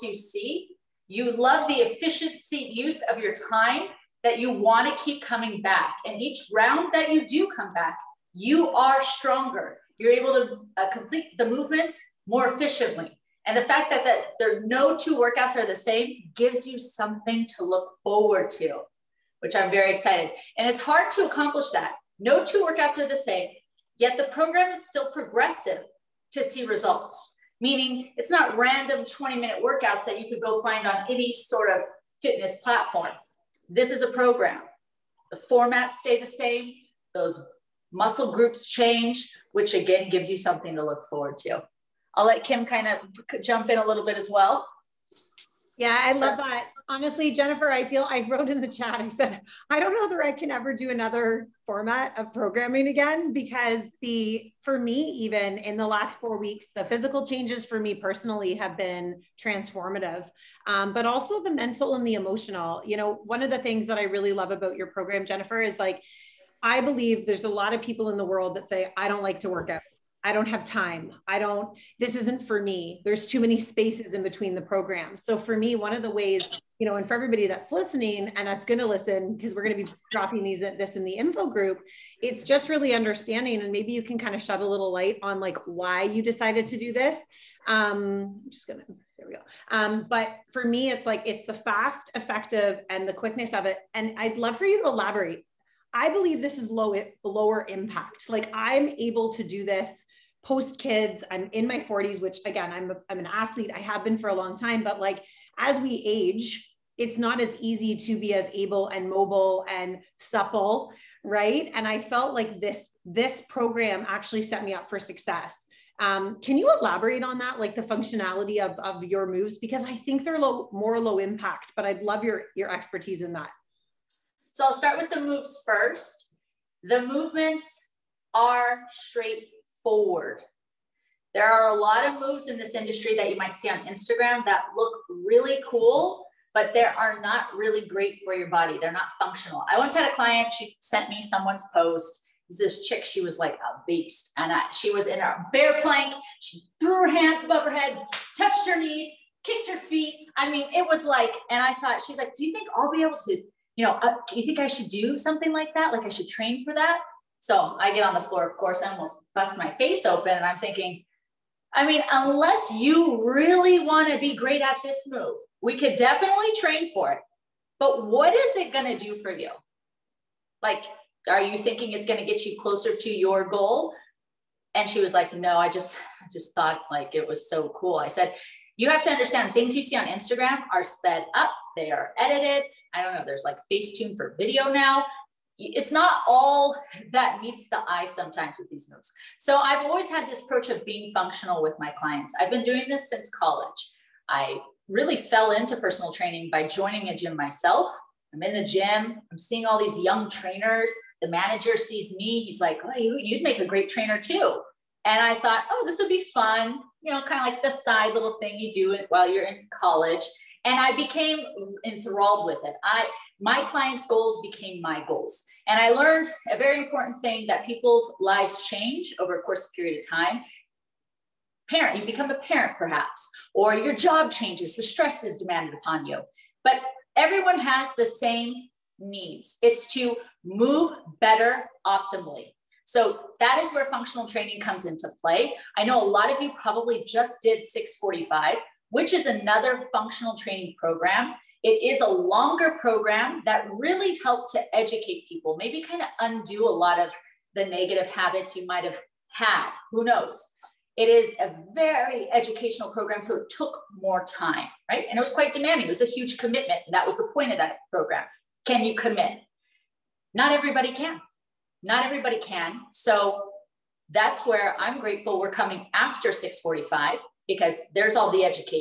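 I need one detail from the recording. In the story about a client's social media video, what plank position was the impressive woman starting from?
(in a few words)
bear plank.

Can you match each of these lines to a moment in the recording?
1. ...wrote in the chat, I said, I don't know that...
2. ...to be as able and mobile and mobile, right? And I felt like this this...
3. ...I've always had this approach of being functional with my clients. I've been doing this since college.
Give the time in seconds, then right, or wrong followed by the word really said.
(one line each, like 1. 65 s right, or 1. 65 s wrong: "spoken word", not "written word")
1. 48 s right
2. 107 s wrong: "supple", not "mobile"
3. 189 s right.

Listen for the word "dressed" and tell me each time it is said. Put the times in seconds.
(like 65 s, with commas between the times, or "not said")
not said.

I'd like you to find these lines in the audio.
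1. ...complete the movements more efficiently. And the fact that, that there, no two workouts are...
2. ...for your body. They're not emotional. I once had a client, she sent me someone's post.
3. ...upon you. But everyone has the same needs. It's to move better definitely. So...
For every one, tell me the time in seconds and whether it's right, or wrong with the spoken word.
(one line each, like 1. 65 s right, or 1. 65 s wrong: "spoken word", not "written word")
1. 10 s right
2. 138 s wrong: "functional", not "emotional"
3. 225 s wrong: "optimally", not "definitely".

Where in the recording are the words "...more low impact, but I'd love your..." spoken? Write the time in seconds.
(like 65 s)
120 s.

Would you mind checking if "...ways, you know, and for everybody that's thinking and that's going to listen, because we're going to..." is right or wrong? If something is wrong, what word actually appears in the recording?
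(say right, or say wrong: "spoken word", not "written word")
wrong: "listening", not "thinking".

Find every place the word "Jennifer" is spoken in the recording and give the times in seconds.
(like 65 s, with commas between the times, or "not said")
47 s, 65 s.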